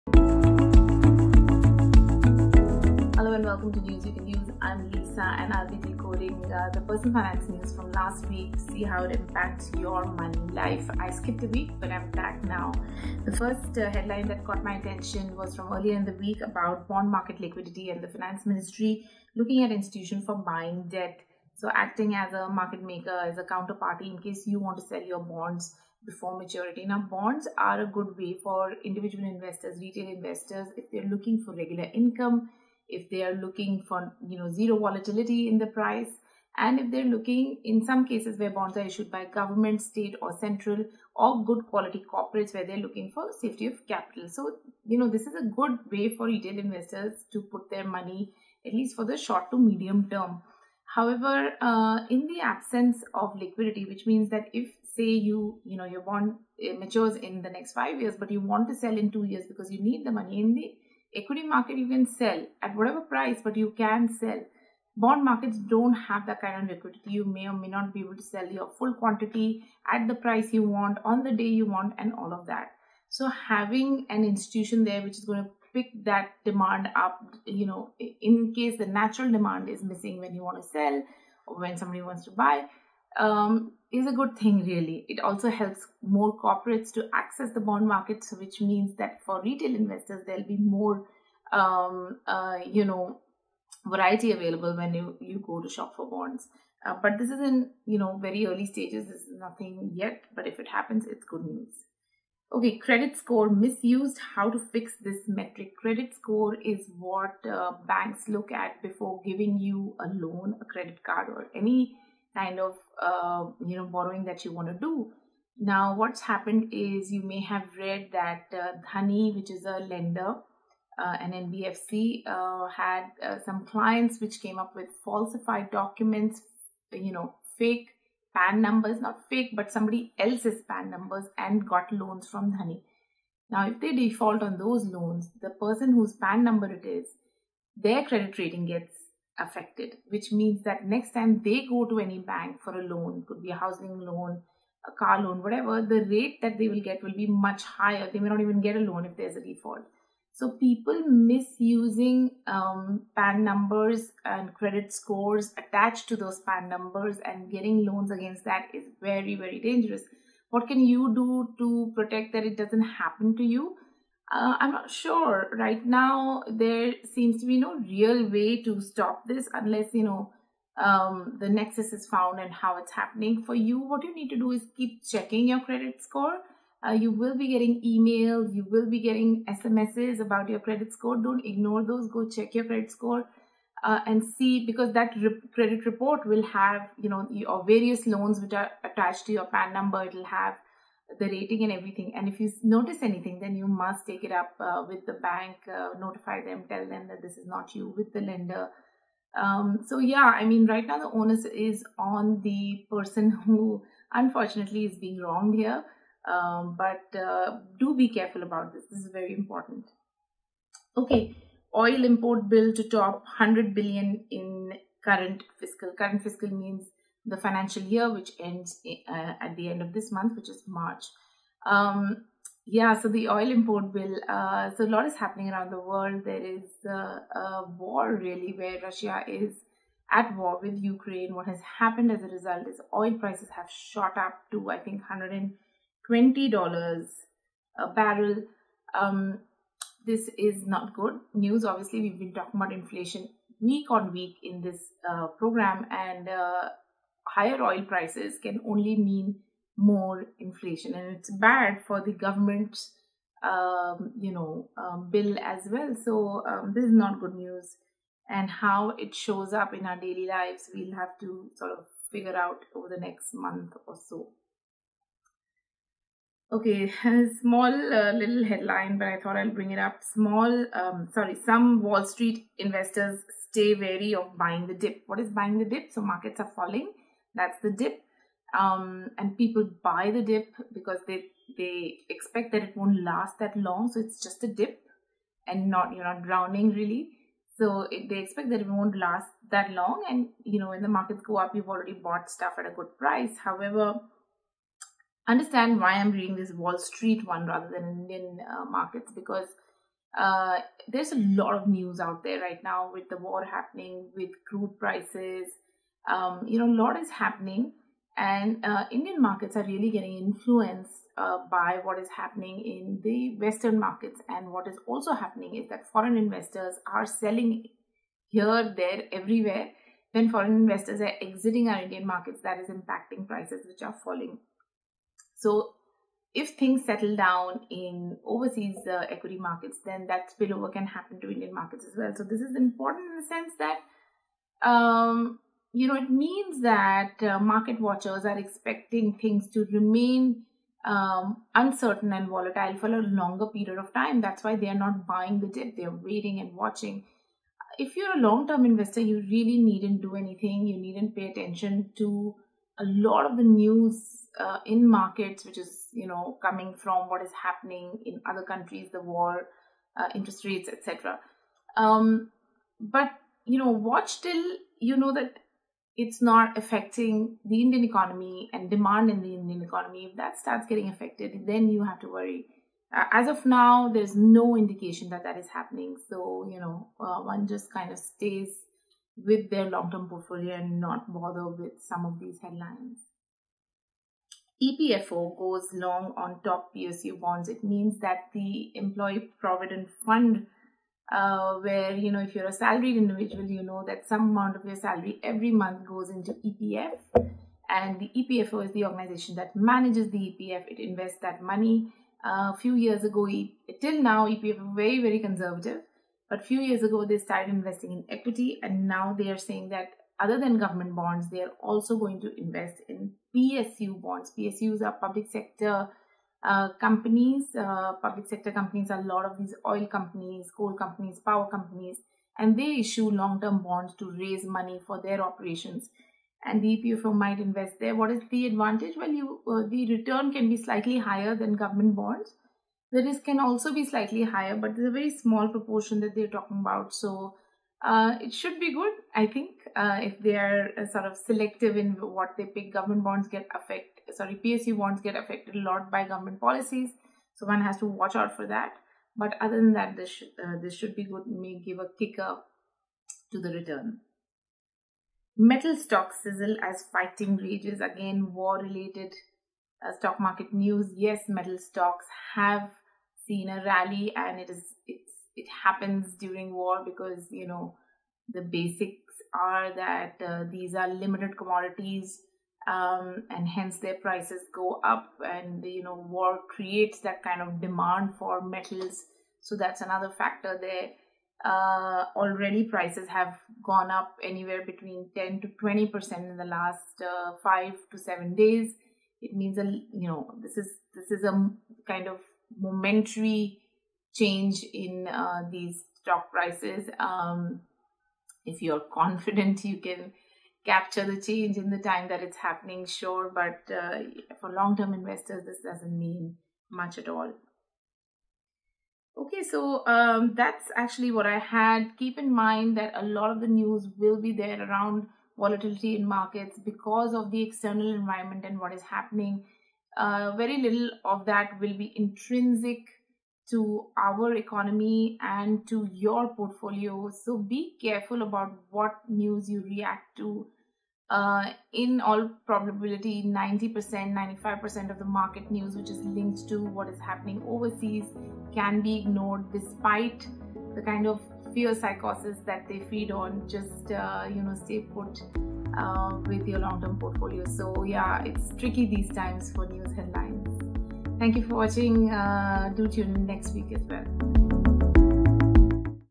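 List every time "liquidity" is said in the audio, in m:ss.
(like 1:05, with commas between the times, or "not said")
0:17, 0:53, 1:06.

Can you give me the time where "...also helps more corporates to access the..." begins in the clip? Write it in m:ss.
1:25.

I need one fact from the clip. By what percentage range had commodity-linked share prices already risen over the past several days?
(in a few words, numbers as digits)
10 to 20 percent.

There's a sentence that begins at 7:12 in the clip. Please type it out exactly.
The risk can also be slightly higher, but it's a very small proportion that they're talking about.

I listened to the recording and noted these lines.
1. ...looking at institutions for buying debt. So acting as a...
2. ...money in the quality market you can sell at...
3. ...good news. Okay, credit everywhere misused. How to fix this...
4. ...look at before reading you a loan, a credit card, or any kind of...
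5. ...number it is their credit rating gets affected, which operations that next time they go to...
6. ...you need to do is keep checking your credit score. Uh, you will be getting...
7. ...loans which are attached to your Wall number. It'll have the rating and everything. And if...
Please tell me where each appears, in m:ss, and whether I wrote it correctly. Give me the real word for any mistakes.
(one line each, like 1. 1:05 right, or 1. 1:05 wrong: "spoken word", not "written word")
1. 0:19 right
2. 1:00 wrong: "equity", not "quality"
3. 1:41 wrong: "score", not "everywhere"
4. 1:48 wrong: "giving", not "reading"
5. 2:16 wrong: "means", not "operations"
6. 2:54 right
7. 3:08 wrong: "PAN", not "Wall".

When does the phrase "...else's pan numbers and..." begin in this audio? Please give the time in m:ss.
2:10.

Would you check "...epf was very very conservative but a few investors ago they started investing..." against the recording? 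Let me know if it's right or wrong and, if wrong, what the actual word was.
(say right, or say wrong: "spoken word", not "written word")
wrong: "years", not "investors".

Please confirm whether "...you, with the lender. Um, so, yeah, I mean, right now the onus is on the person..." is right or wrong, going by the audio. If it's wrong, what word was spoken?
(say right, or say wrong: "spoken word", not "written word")
right.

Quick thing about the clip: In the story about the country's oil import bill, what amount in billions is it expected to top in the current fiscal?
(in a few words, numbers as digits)
100 billion.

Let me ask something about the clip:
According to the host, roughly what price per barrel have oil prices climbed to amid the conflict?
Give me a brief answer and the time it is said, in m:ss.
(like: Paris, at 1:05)
$120, at 3:55.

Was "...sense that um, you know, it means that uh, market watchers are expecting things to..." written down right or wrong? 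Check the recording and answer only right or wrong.
right.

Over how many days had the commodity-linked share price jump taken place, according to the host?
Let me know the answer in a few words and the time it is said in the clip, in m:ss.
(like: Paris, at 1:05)
5 to 7 days, at 8:07.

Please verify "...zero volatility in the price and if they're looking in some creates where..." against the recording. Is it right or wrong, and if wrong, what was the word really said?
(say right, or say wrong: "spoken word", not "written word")
wrong: "cases", not "creates".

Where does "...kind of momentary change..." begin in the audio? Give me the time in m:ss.
8:11.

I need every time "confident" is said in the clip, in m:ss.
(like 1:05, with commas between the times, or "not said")
8:18.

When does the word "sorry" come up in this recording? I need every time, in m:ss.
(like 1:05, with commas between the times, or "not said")
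4:31, 7:24.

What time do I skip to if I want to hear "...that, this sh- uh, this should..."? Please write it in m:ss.
7:29.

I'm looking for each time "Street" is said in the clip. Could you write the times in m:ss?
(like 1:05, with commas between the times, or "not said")
4:32, 4:56.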